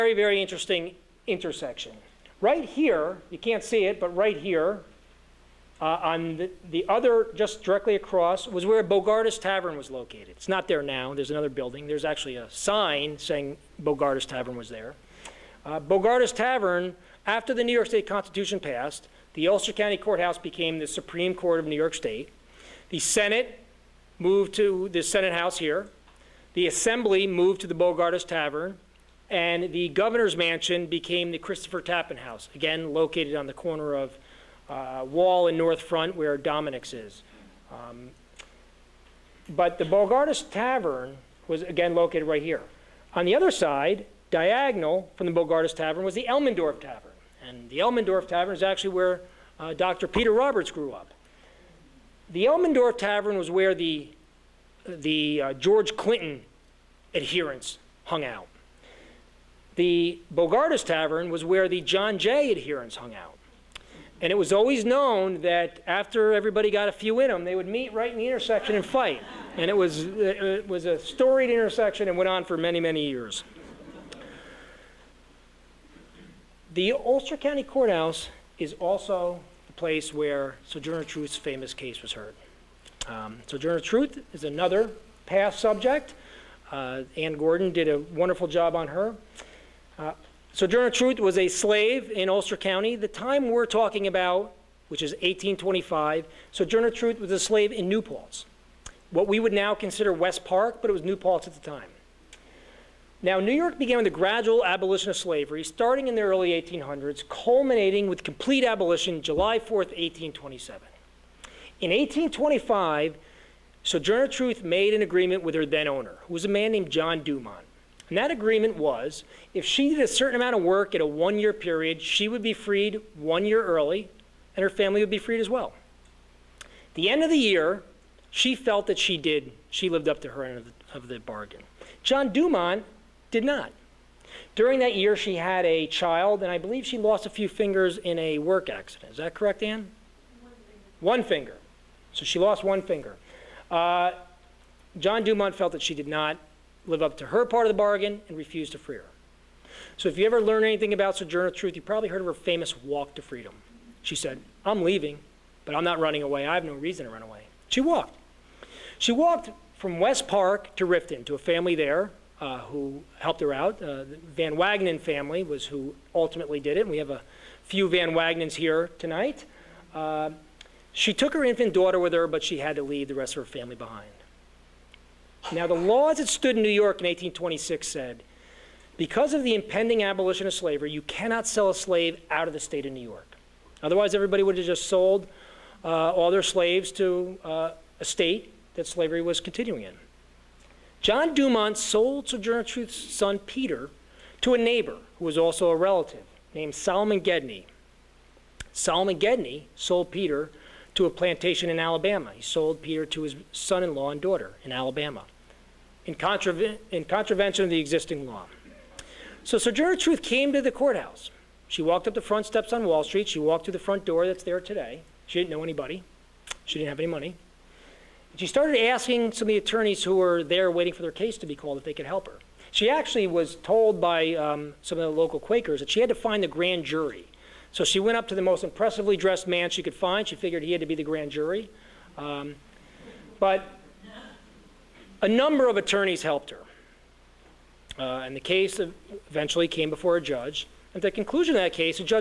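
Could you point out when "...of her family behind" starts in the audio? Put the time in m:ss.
2:53.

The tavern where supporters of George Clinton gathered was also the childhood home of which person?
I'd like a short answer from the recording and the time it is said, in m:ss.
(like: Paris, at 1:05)
Dr. Peter Roberts, at 0:49.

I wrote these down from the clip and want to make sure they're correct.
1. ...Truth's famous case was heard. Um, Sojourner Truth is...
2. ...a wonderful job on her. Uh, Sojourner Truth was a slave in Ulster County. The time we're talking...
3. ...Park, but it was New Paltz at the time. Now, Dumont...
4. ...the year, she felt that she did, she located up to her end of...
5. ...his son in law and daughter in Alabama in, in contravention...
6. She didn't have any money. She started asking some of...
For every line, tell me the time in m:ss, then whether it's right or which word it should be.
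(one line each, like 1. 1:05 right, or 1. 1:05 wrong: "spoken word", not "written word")
1. 1:21 right
2. 1:27 right
3. 1:40 wrong: "New", not "Dumont"
4. 2:07 wrong: "lived", not "located"
5. 3:23 right
6. 3:36 right.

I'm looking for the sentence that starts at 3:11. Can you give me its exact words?
John Dumont sold Sojourner Truth's son Peter to a neighbor who was also a relative named Solomon Gedney.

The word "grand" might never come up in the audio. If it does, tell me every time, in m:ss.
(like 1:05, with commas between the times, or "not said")
3:46, 3:51.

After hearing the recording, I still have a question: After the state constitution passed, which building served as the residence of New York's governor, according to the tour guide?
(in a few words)
Christopher Tappan House.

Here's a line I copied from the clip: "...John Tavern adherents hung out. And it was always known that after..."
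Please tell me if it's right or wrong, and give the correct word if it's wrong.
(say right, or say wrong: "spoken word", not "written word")
wrong: "Jay", not "Tavern".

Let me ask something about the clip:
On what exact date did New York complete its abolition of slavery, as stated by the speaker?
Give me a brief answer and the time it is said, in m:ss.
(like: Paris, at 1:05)
July 4th, 1827, at 1:49.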